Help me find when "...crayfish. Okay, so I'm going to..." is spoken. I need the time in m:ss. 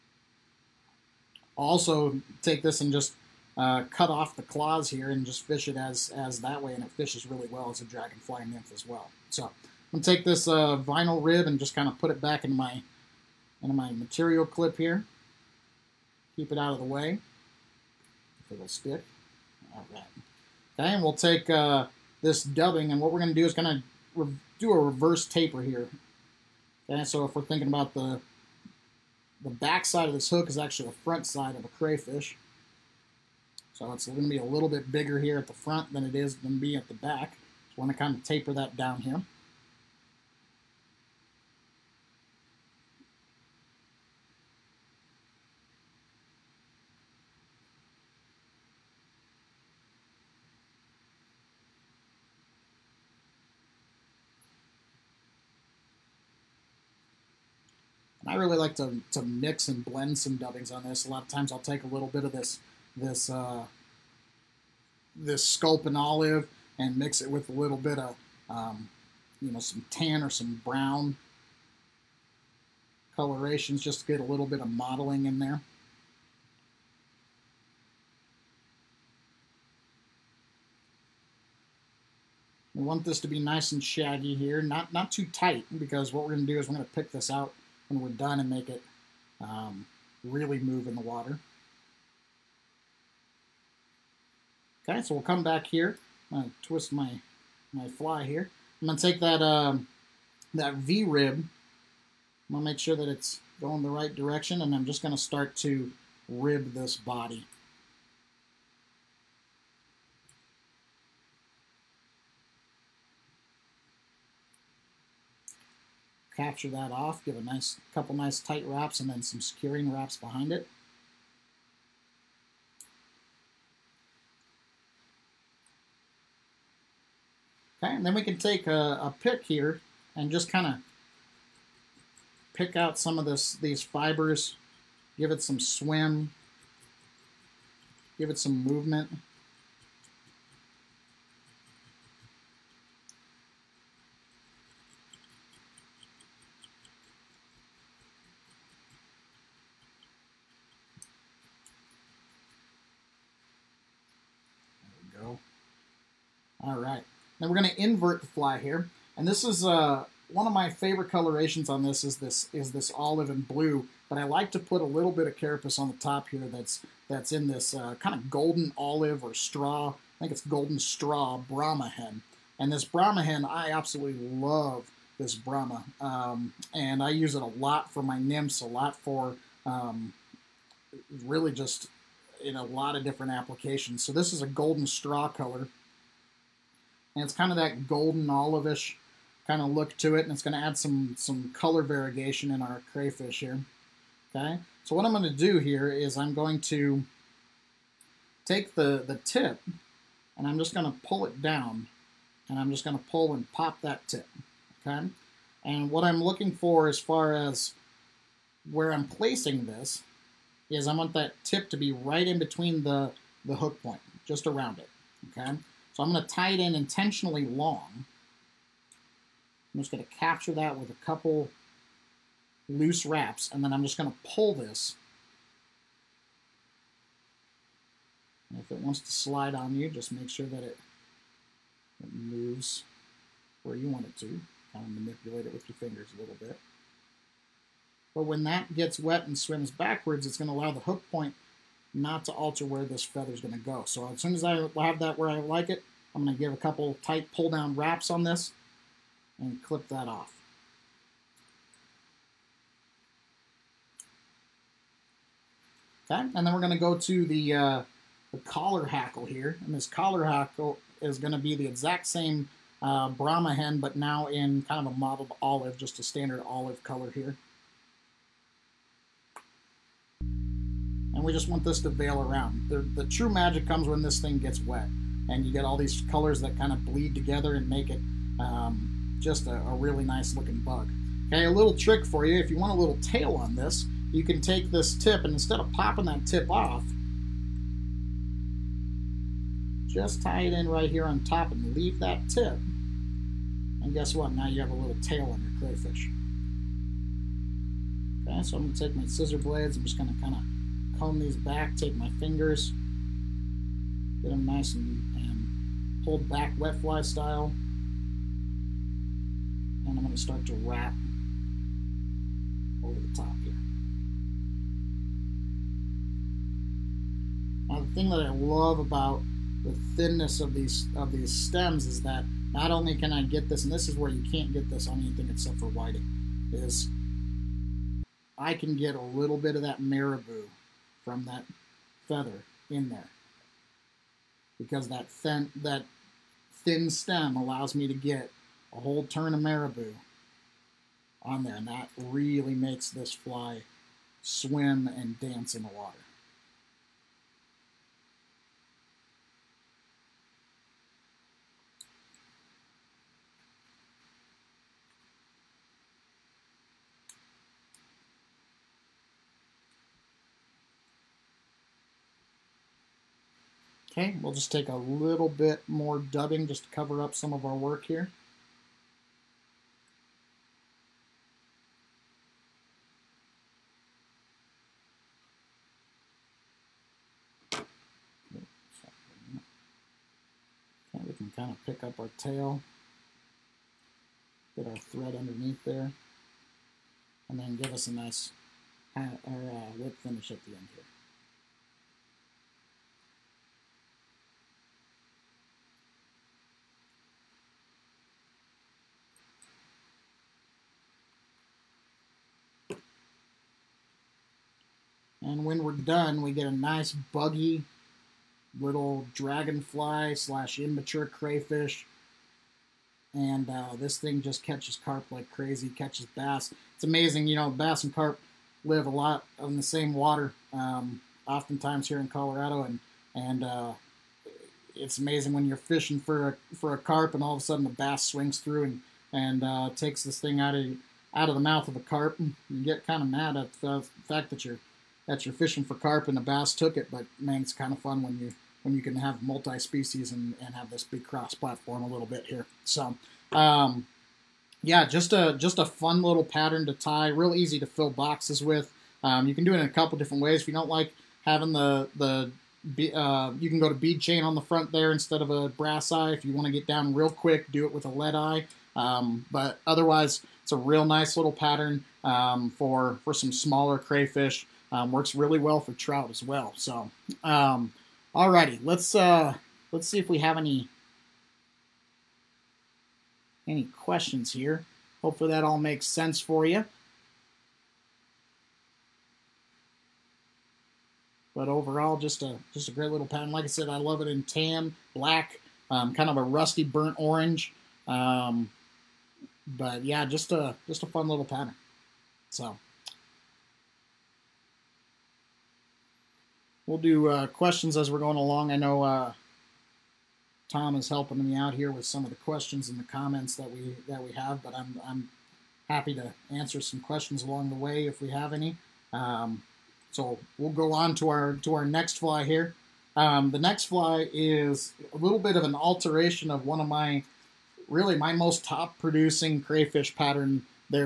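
4:55.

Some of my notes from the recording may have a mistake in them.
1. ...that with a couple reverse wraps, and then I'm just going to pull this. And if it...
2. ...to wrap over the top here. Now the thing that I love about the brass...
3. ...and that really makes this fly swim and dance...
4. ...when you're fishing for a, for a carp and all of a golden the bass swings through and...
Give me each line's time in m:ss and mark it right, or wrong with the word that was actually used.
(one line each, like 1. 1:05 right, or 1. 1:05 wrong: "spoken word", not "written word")
1. 3:40 wrong: "loose", not "reverse"
2. 5:10 wrong: "thinness", not "brass"
3. 5:41 right
4. 7:05 wrong: "sudden", not "golden".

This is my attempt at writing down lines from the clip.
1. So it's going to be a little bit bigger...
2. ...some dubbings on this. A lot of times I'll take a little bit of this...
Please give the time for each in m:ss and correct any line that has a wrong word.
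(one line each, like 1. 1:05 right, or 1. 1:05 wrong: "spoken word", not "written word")
1. 0:33 right
2. 1:00 right.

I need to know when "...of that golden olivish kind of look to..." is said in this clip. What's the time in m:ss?
3:07.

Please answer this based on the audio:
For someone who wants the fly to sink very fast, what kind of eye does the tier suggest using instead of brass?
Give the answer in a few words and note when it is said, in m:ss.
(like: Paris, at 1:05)
lead eye, at 7:37.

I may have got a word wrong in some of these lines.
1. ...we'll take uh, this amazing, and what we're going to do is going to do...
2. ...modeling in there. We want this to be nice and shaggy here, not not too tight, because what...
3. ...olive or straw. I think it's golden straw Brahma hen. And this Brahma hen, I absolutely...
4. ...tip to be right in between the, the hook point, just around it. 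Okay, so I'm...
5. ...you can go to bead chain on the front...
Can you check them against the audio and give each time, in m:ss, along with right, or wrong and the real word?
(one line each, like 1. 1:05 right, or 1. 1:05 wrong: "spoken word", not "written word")
1. 0:21 wrong: "dubbing", not "amazing"
2. 1:14 right
3. 2:48 right
4. 3:31 right
5. 7:33 right.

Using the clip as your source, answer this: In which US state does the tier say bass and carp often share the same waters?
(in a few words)
Colorado.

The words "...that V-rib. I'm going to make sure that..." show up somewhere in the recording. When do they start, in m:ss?
1:40.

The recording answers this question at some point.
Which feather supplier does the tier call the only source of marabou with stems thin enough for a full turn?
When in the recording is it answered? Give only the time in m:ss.
5:25.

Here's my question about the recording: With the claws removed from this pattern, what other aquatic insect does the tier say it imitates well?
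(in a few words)
dragonfly nymph.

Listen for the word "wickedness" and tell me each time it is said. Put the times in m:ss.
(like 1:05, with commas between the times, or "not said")
not said.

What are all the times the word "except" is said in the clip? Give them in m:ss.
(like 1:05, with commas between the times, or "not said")
5:25.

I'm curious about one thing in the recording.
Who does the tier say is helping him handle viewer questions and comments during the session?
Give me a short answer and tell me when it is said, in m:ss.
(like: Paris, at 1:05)
Tom, at 8:20.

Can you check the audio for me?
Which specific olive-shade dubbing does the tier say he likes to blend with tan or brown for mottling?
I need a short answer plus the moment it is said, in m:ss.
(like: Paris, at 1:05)
sculpin olive, at 1:05.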